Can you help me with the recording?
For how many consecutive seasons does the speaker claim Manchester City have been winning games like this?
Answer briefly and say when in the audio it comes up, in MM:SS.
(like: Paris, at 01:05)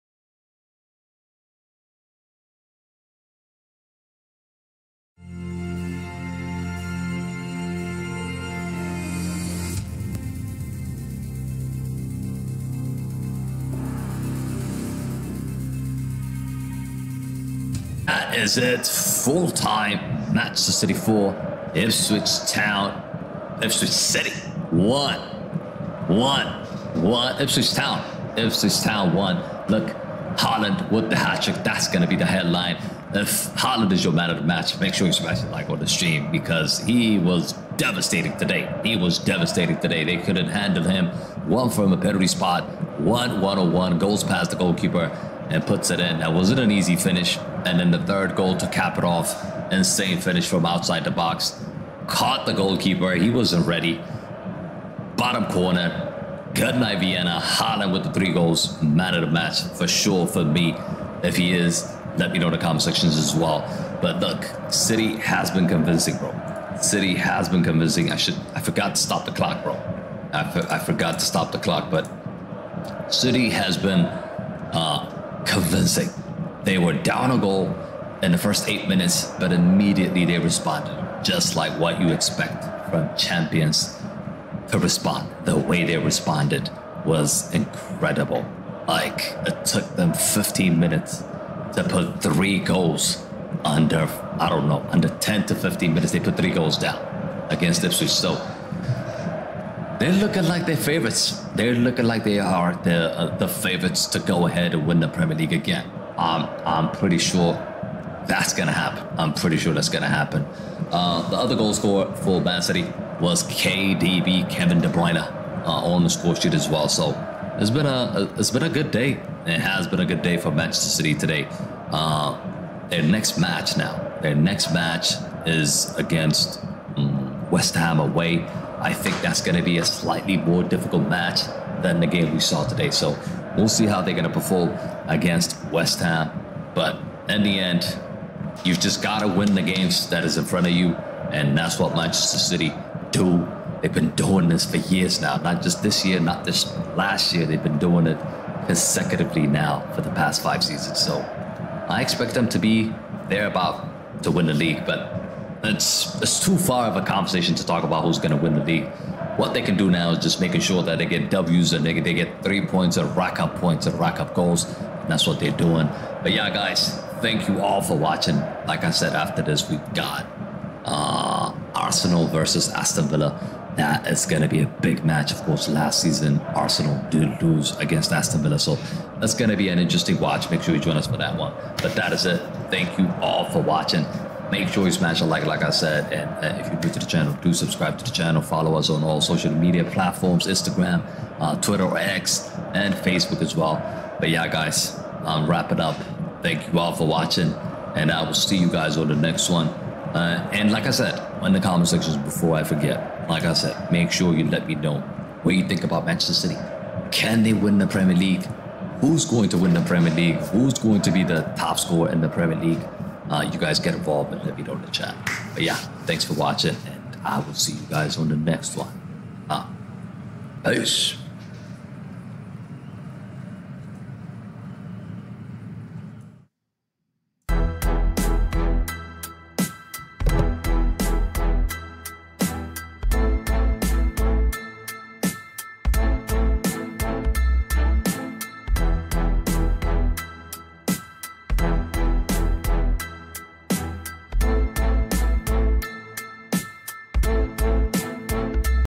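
5, at 02:30.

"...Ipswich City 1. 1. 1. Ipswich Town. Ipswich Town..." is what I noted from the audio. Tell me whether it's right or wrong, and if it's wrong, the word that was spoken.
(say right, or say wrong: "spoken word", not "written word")
right.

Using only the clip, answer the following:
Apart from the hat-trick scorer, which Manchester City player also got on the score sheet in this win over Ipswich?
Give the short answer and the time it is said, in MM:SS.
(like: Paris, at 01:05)
Kevin De Bruyne, at 01:54.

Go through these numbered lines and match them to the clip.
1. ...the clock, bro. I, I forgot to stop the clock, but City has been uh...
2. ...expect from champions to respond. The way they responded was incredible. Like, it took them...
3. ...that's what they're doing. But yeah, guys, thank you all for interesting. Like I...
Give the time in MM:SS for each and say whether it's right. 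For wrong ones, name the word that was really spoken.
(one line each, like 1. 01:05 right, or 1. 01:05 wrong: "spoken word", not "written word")
1. 01:09 right
2. 01:22 right
3. 02:45 wrong: "watching", not "interesting".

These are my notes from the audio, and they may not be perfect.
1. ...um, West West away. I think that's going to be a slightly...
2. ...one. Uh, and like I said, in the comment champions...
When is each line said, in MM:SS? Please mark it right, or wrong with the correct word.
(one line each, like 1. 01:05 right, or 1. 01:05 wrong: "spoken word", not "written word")
1. 02:06 wrong: "Ham", not "West"
2. 03:19 wrong: "sections", not "champions".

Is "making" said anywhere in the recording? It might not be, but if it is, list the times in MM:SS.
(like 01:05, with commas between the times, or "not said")
02:40.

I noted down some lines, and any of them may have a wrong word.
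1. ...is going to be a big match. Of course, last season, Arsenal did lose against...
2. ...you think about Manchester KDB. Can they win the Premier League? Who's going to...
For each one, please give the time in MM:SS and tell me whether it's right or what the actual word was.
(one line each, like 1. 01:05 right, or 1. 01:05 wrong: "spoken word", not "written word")
1. 02:54 right
2. 03:25 wrong: "City", not "KDB".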